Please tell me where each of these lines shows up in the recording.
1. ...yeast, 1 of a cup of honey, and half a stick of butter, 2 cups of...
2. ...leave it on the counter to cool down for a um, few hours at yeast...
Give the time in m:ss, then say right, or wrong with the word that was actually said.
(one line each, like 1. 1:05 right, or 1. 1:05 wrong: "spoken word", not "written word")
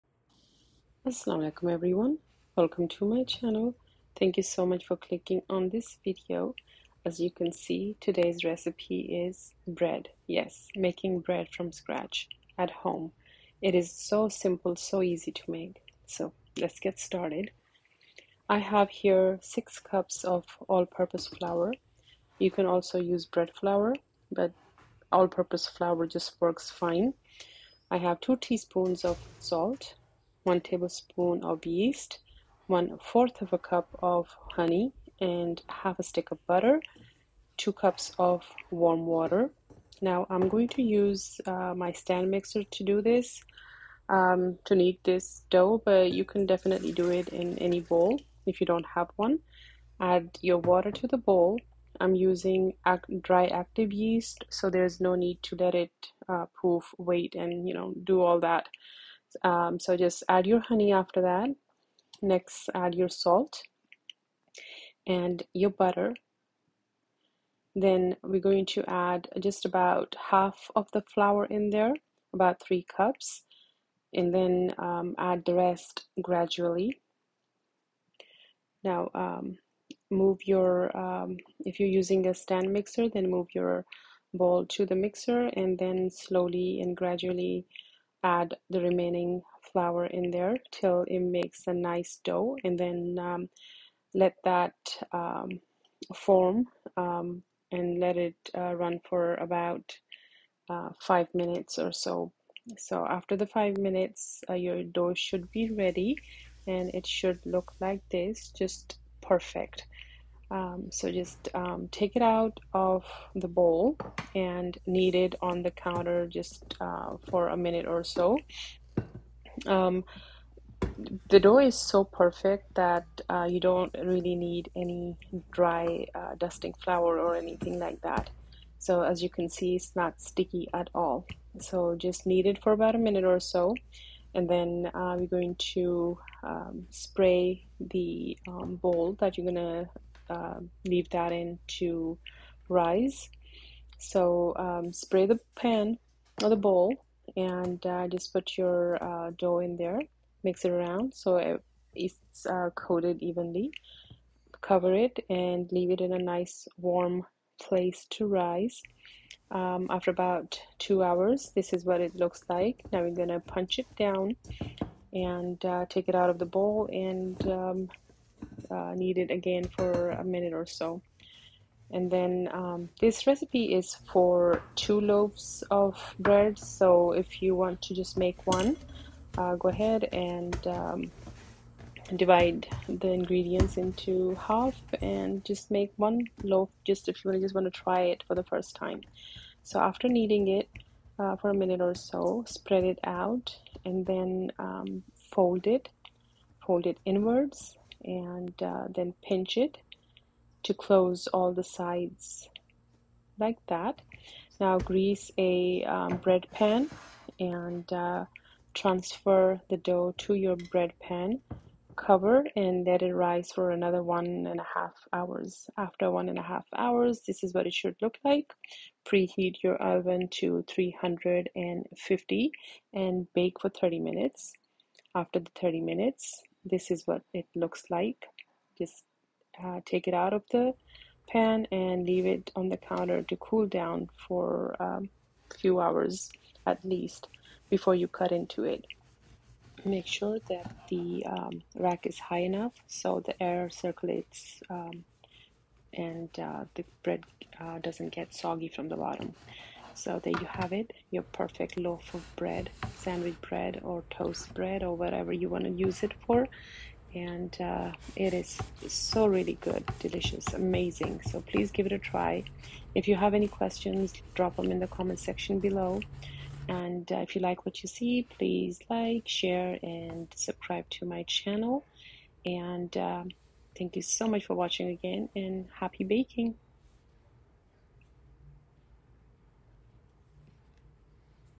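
1. 0:31 right
2. 3:52 wrong: "least", not "yeast".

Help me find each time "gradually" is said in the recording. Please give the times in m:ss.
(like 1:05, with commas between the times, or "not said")
1:16, 1:26.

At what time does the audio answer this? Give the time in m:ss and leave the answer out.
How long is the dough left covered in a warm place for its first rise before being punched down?
2:40.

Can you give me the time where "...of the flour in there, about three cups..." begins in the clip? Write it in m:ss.
1:10.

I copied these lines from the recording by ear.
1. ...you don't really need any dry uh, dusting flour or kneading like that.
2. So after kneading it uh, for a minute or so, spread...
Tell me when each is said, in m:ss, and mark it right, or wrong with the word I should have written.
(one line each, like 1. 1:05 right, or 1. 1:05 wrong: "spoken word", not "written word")
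1. 2:03 wrong: "anything", not "kneading"
2. 3:09 right.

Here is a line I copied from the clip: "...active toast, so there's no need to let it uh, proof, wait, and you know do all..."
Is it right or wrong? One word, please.
wrong.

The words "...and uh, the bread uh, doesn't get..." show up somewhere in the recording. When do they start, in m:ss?
4:05.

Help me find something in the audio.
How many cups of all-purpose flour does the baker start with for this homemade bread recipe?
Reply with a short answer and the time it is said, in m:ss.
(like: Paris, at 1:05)
6 cups, at 0:19.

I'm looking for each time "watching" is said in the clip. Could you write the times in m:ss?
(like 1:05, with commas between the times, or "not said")
4:34.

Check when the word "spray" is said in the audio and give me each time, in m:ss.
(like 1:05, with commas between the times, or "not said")
2:16, 2:24.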